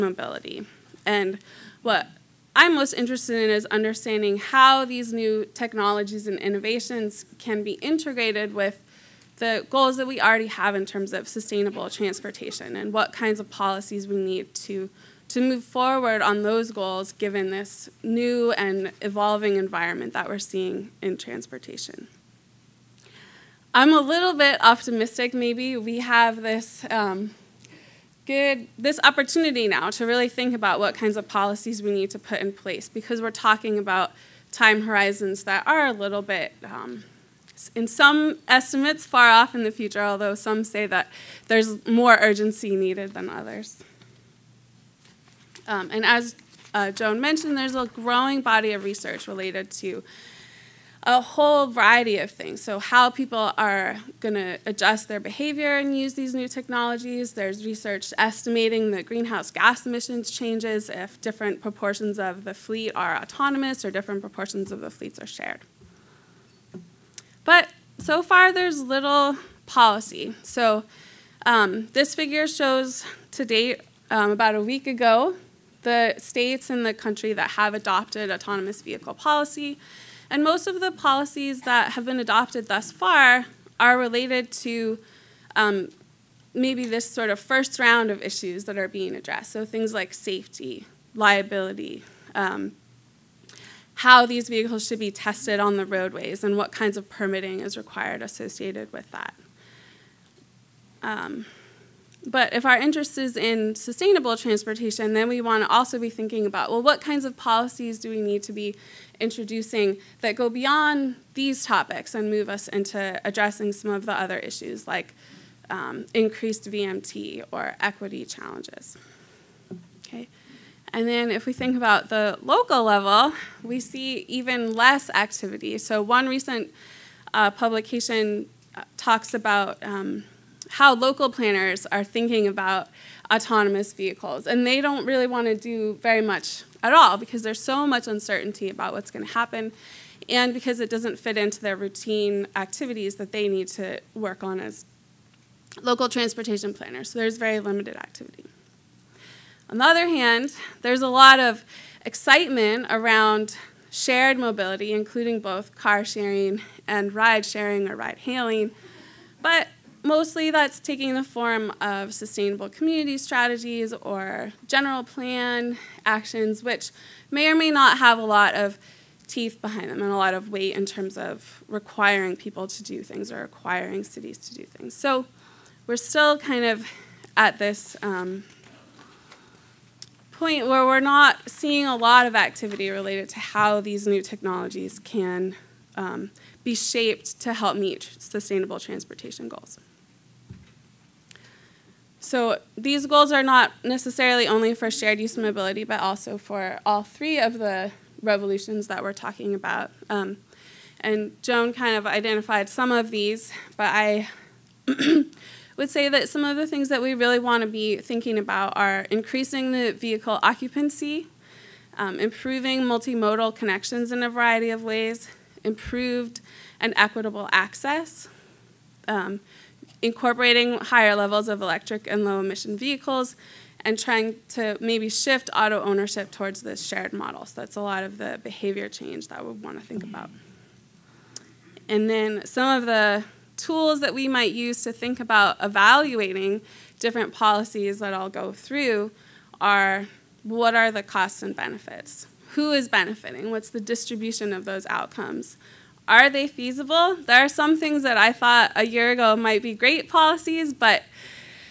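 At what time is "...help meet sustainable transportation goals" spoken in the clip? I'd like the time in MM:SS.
03:07.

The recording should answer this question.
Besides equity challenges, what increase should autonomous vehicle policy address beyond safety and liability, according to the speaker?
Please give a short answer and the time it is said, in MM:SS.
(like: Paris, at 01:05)
Increased VMT, at 01:56.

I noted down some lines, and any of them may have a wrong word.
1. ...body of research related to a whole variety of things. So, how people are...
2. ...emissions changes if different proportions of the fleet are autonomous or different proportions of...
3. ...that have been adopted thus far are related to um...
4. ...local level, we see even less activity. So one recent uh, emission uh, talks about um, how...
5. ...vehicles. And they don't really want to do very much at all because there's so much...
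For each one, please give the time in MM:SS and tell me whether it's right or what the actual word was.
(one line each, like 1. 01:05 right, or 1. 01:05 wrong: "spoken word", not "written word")
1. 00:48 right
2. 00:59 right
3. 01:21 right
4. 02:02 wrong: "publication", not "emission"
5. 02:13 right.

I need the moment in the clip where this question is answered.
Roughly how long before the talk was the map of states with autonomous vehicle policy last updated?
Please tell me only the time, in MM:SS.
01:14.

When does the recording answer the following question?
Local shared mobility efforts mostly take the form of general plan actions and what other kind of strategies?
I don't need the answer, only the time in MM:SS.
02:42.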